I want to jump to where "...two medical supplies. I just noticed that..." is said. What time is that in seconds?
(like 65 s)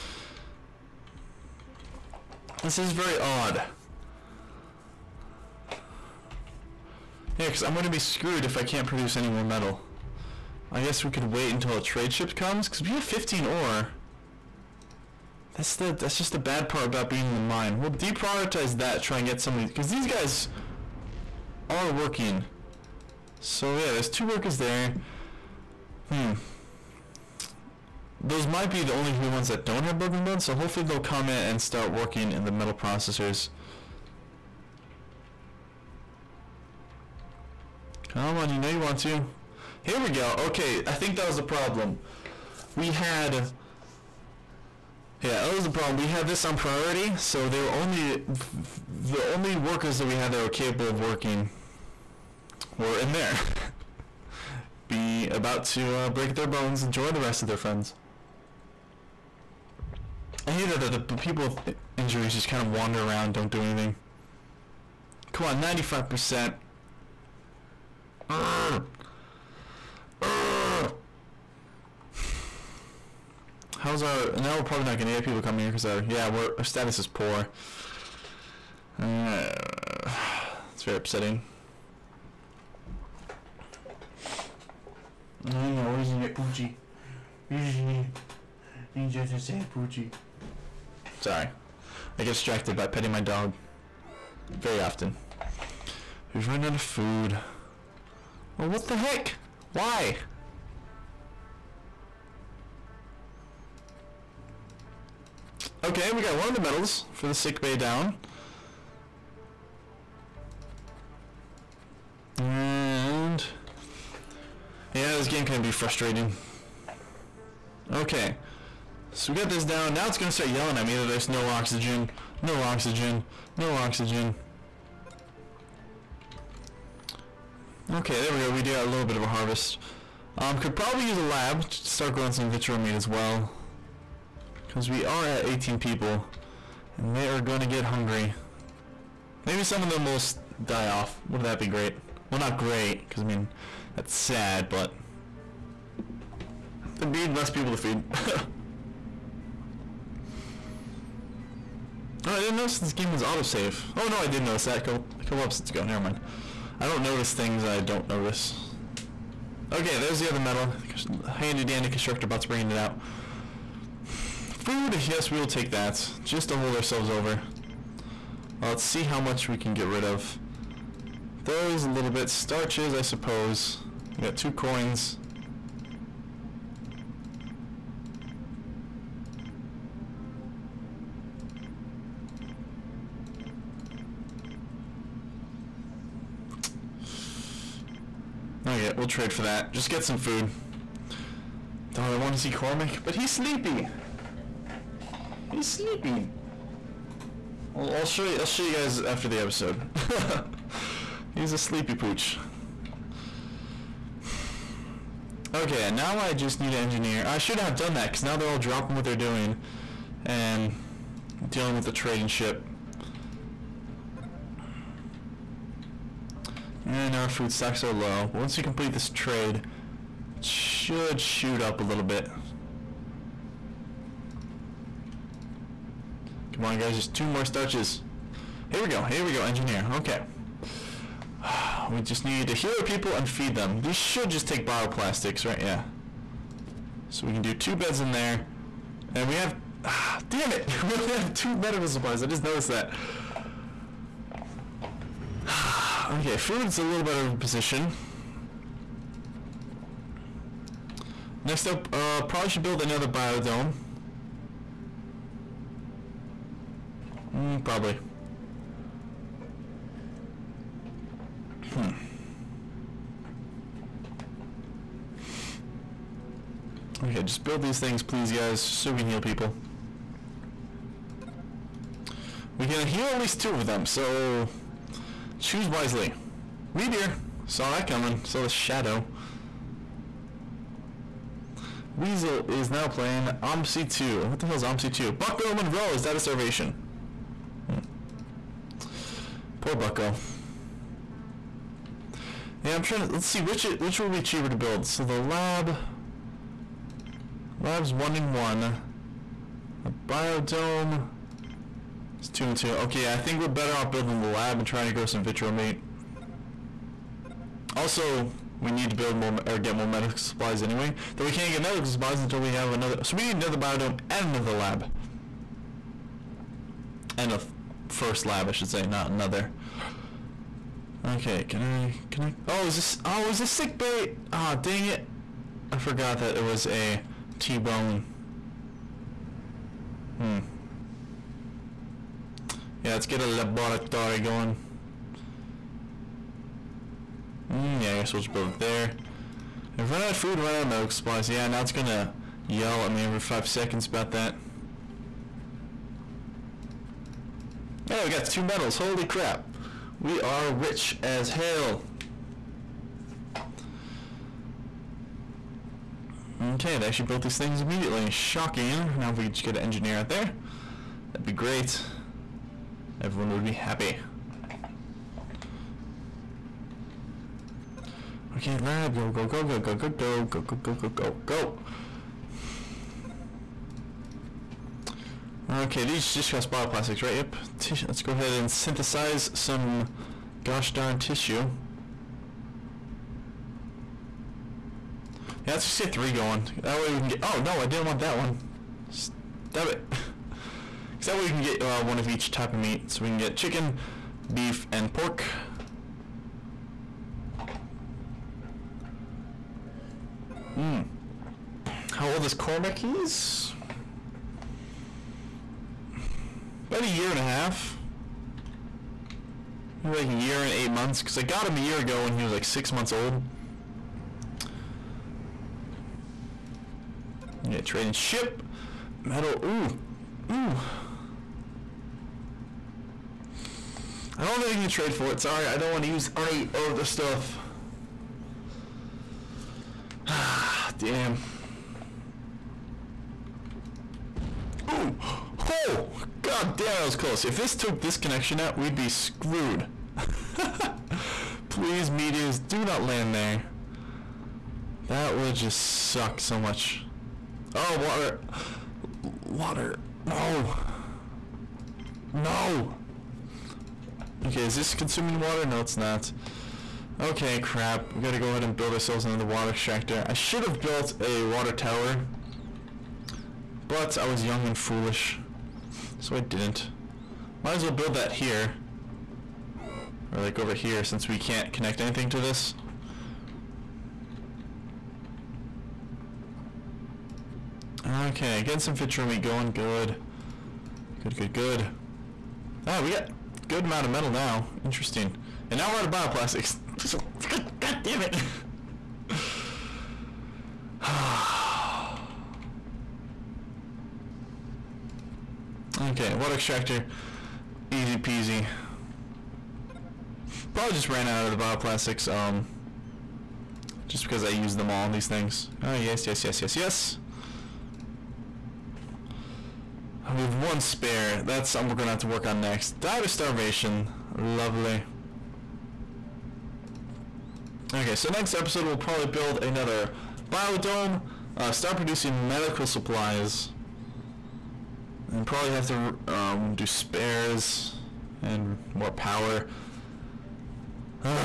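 241 s.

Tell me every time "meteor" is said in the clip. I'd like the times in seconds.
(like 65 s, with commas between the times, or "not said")
276 s, 441 s.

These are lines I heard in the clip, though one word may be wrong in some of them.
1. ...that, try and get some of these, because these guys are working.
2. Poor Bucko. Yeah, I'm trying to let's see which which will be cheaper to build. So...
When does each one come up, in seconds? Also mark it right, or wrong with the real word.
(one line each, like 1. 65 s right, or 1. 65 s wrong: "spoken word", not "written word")
1. 18 s right
2. 289 s right.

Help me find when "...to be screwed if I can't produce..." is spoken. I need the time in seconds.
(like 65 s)
7 s.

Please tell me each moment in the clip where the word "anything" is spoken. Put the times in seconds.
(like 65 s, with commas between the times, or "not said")
63 s, 424 s, 471 s.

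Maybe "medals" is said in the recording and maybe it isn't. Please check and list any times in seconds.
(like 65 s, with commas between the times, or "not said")
106 s, 348 s.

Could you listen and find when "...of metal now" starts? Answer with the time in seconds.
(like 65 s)
483 s.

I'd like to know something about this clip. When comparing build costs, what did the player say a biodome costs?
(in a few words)
two and two.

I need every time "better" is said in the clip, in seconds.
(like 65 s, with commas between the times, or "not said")
247 s, 303 s.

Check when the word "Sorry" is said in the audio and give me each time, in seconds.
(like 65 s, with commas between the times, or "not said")
91 s, 425 s.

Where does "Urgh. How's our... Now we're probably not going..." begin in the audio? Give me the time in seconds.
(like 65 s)
70 s.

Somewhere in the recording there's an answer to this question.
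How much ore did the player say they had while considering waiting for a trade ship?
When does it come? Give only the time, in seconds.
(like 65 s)
13 s.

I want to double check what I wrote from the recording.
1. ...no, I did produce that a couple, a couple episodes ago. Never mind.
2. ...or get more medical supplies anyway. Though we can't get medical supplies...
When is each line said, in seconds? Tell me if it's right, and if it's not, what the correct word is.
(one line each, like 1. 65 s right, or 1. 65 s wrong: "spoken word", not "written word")
1. 154 s wrong: "notice", not "produce"
2. 309 s right.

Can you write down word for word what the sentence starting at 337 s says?
Mm, yeah, I guess we'll just build it there.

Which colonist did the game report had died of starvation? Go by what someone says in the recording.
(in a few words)
Bucko Monroe.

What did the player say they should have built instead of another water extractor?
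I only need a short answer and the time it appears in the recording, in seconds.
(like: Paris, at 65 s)
A water tower, at 461 s.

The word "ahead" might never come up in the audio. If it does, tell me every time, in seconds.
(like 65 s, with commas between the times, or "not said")
378 s, 458 s.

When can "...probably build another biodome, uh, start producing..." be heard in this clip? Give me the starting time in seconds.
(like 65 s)
518 s.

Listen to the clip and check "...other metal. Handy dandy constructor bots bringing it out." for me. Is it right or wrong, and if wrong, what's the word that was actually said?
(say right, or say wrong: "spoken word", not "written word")
right.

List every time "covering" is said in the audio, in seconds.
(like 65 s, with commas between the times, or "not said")
not said.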